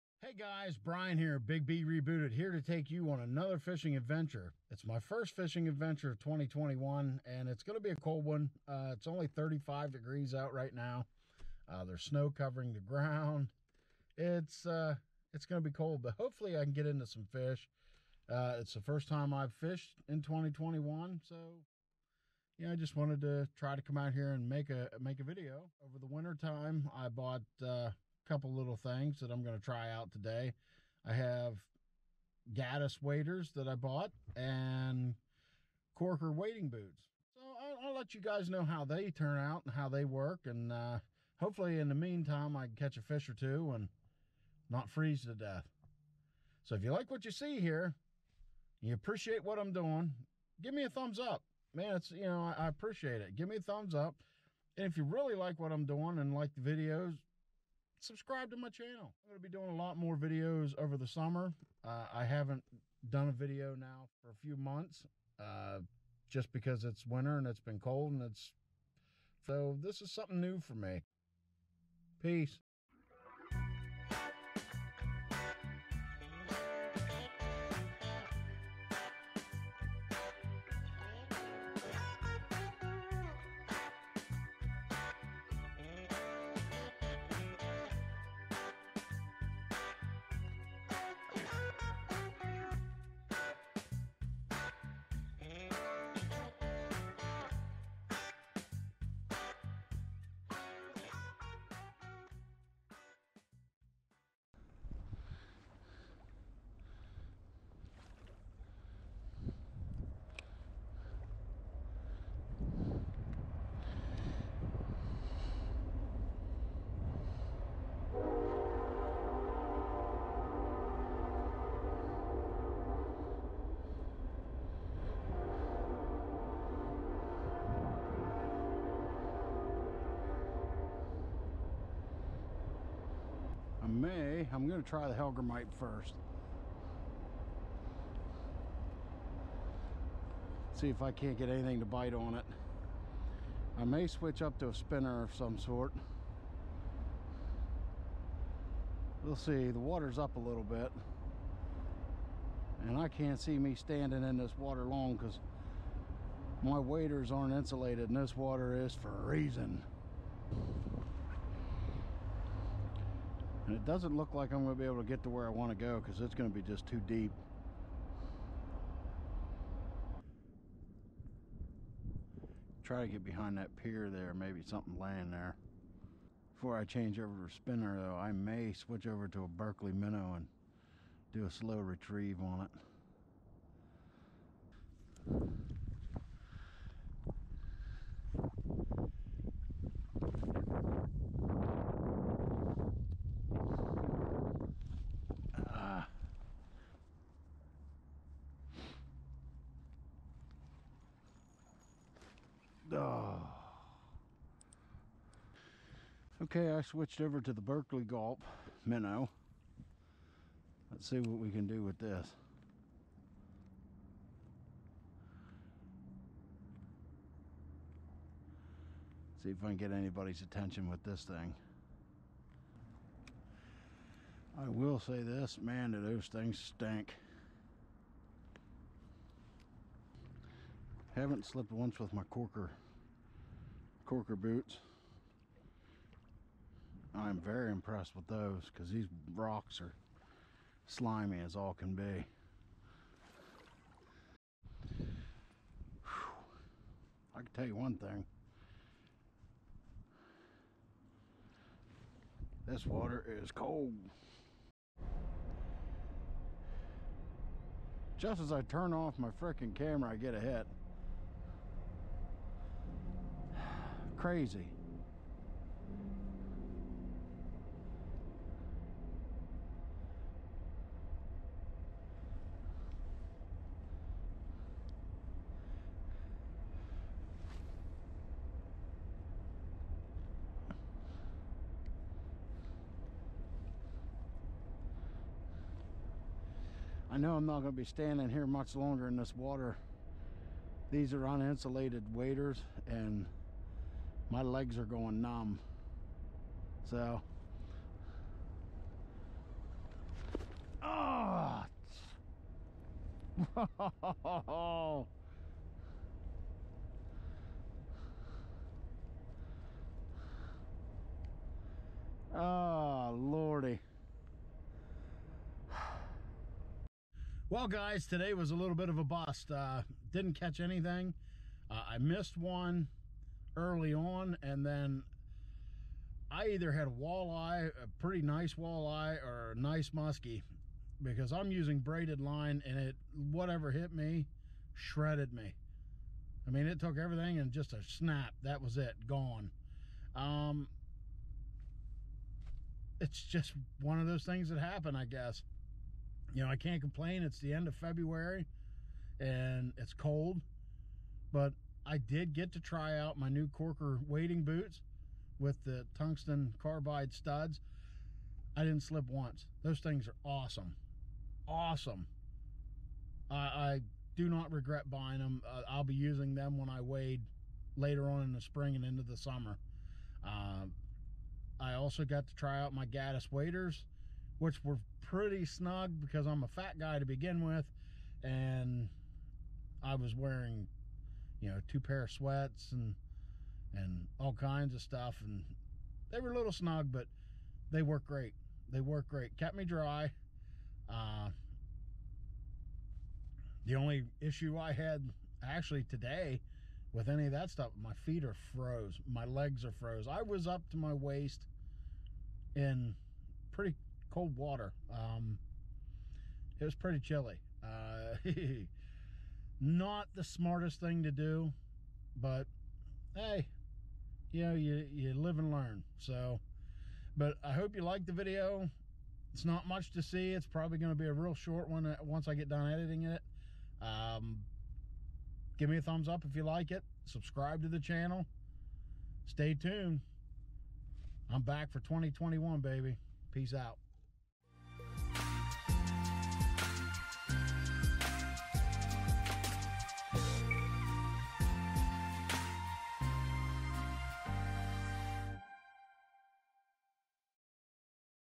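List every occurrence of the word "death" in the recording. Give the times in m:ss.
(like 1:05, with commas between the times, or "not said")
0:45.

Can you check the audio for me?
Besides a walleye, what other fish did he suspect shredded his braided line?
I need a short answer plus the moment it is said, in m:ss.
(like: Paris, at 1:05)
muskie, at 5:29.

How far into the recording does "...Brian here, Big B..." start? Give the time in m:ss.
0:00.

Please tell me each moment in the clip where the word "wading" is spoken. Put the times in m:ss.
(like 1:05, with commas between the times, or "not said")
0:36, 5:54.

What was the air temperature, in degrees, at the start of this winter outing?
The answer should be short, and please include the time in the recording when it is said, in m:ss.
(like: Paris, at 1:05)
35, at 0:09.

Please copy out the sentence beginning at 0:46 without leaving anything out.
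So if you like what you see here, you appreciate what I'm doing, give me a thumbs up.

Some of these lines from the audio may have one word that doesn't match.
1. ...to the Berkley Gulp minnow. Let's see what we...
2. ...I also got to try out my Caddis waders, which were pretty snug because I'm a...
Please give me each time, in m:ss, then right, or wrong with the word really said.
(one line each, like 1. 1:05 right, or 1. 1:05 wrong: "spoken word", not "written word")
1. 3:27 right
2. 6:11 right.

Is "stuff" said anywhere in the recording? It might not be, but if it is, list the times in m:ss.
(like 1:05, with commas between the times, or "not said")
6:24, 6:37.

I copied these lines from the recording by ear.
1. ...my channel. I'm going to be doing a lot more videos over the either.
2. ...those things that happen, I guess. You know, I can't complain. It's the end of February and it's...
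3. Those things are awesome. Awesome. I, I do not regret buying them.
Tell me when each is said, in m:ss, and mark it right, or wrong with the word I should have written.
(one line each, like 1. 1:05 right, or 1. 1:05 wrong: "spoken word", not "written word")
1. 0:58 wrong: "summer", not "either"
2. 5:44 right
3. 5:59 right.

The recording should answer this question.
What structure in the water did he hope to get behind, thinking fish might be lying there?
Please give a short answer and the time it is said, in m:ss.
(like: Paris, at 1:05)
pier, at 2:53.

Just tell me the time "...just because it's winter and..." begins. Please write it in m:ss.
1:06.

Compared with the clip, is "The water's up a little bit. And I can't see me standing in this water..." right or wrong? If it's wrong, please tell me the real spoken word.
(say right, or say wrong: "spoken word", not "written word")
right.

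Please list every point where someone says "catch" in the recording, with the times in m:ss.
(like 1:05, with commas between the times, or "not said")
0:42, 5:20.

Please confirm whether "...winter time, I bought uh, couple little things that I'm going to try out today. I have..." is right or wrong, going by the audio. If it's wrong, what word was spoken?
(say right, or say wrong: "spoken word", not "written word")
right.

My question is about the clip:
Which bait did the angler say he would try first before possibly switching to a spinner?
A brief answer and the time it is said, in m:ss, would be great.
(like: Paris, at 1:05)
hellgrammite, at 2:15.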